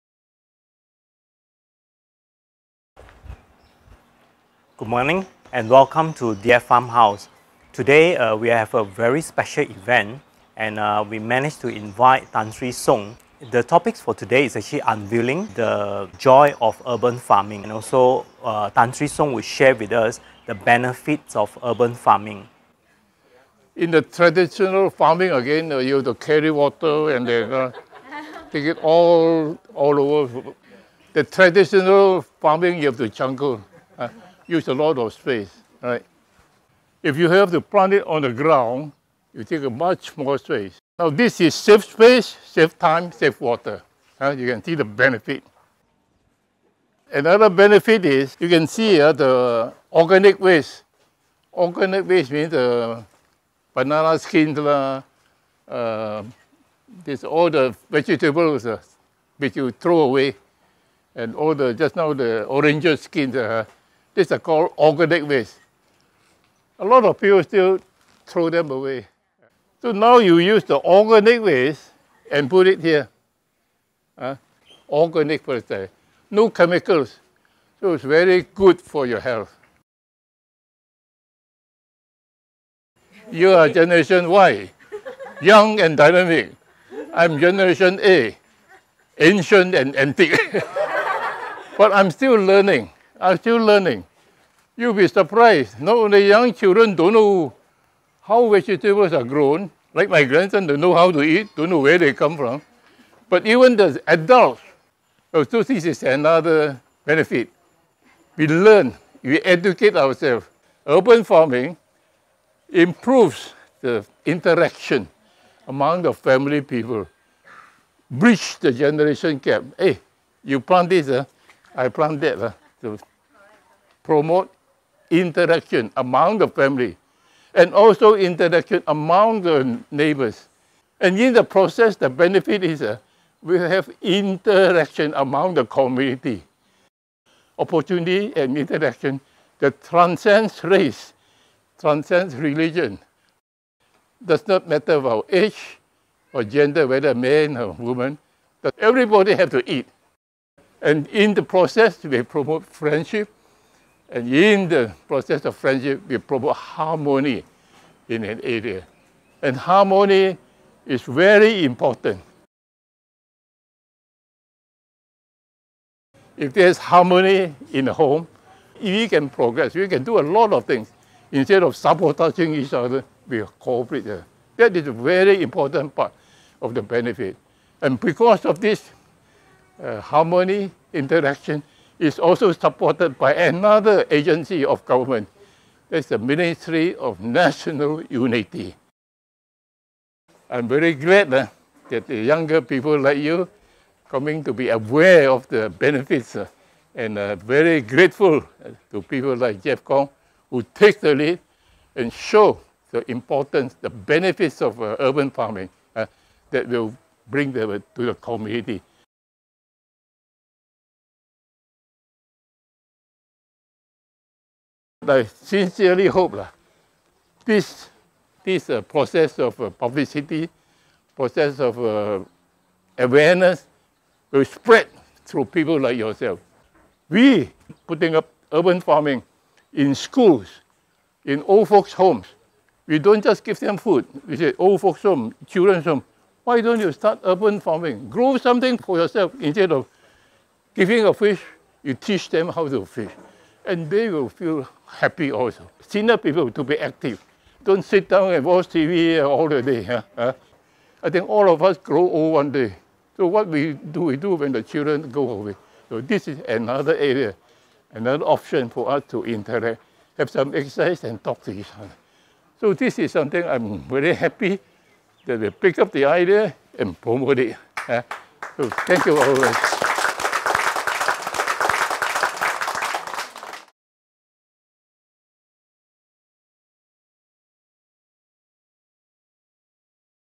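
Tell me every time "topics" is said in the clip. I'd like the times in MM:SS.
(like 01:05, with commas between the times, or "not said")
00:13.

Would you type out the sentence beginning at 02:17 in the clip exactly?
Opportunity and interaction that transcends race, transcends religion.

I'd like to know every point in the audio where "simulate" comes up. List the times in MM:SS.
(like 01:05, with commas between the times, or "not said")
not said.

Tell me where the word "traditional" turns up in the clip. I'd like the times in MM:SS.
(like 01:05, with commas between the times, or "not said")
00:24, 00:31.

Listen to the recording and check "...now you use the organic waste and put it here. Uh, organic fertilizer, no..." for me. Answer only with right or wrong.
right.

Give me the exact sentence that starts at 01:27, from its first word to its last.
I'm generation A, ancient and antique.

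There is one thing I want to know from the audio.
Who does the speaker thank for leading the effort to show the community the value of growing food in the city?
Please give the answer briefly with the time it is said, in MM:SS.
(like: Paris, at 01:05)
Jeff Kong, at 03:19.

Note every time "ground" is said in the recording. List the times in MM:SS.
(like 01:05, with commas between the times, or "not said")
00:38.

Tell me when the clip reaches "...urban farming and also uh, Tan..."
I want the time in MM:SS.
00:16.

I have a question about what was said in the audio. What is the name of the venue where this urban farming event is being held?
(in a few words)
Deer Farmhouse.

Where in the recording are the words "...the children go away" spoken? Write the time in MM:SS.
04:14.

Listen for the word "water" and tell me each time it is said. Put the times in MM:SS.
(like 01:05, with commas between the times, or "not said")
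00:26, 00:43.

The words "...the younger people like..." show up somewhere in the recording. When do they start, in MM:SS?
03:12.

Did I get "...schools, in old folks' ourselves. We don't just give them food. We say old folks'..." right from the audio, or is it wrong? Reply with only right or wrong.
wrong.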